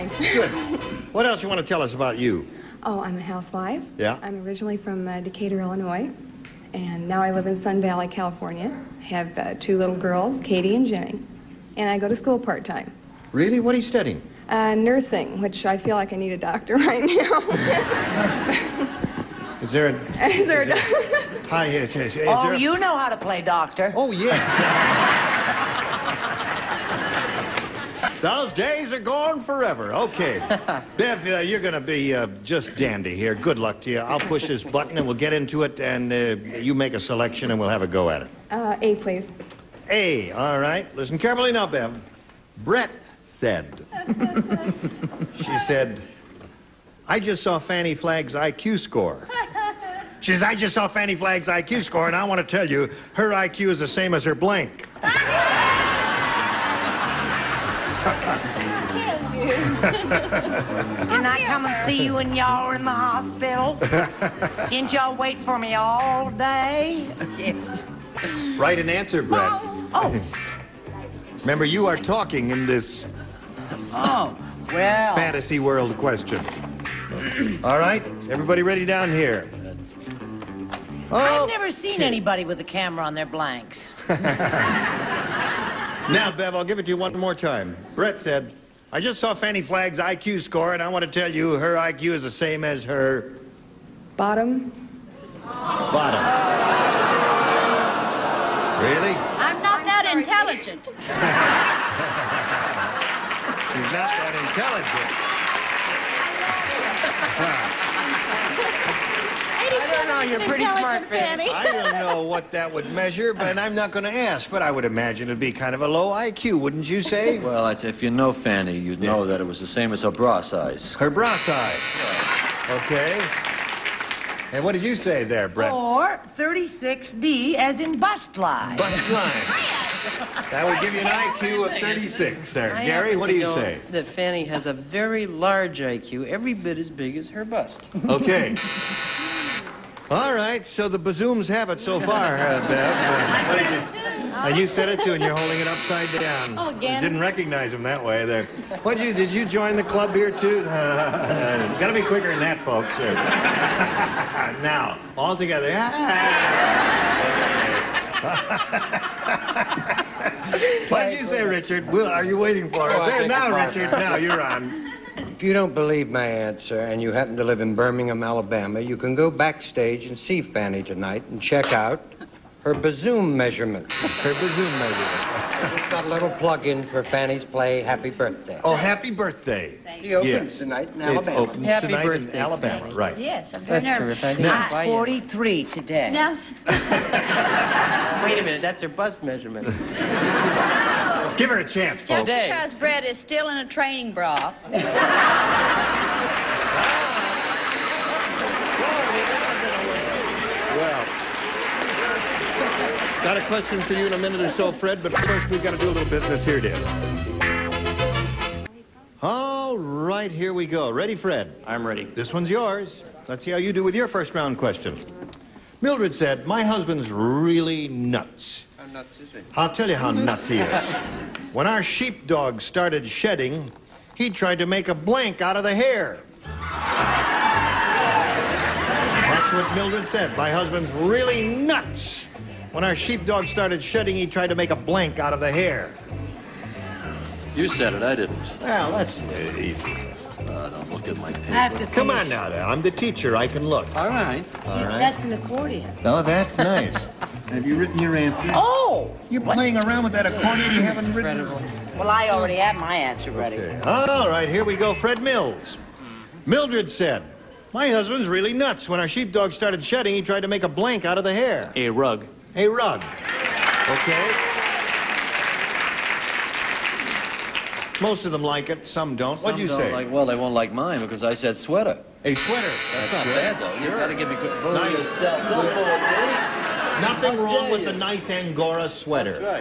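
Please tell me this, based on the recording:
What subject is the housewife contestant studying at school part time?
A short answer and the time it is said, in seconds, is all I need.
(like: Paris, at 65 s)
Nursing, at 14 s.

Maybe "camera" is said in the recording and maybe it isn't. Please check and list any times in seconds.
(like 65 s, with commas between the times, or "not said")
82 s.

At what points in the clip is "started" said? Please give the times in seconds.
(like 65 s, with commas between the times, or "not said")
222 s, 233 s, 259 s.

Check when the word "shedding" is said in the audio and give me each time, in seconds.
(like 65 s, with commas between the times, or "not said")
223 s, 233 s, 259 s.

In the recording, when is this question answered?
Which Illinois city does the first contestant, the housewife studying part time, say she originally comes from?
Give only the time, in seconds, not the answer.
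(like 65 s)
5 s.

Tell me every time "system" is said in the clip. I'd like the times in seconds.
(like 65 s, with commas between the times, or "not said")
not said.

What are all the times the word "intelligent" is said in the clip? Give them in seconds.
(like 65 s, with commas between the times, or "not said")
100 s, 107 s.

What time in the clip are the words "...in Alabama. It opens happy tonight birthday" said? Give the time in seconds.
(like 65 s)
180 s.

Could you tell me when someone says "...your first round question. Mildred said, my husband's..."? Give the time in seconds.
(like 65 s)
213 s.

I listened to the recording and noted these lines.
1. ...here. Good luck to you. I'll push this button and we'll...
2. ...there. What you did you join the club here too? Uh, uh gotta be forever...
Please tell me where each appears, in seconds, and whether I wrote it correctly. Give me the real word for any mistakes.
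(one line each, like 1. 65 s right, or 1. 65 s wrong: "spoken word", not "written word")
1. 33 s right
2. 148 s wrong: "quicker", not "forever".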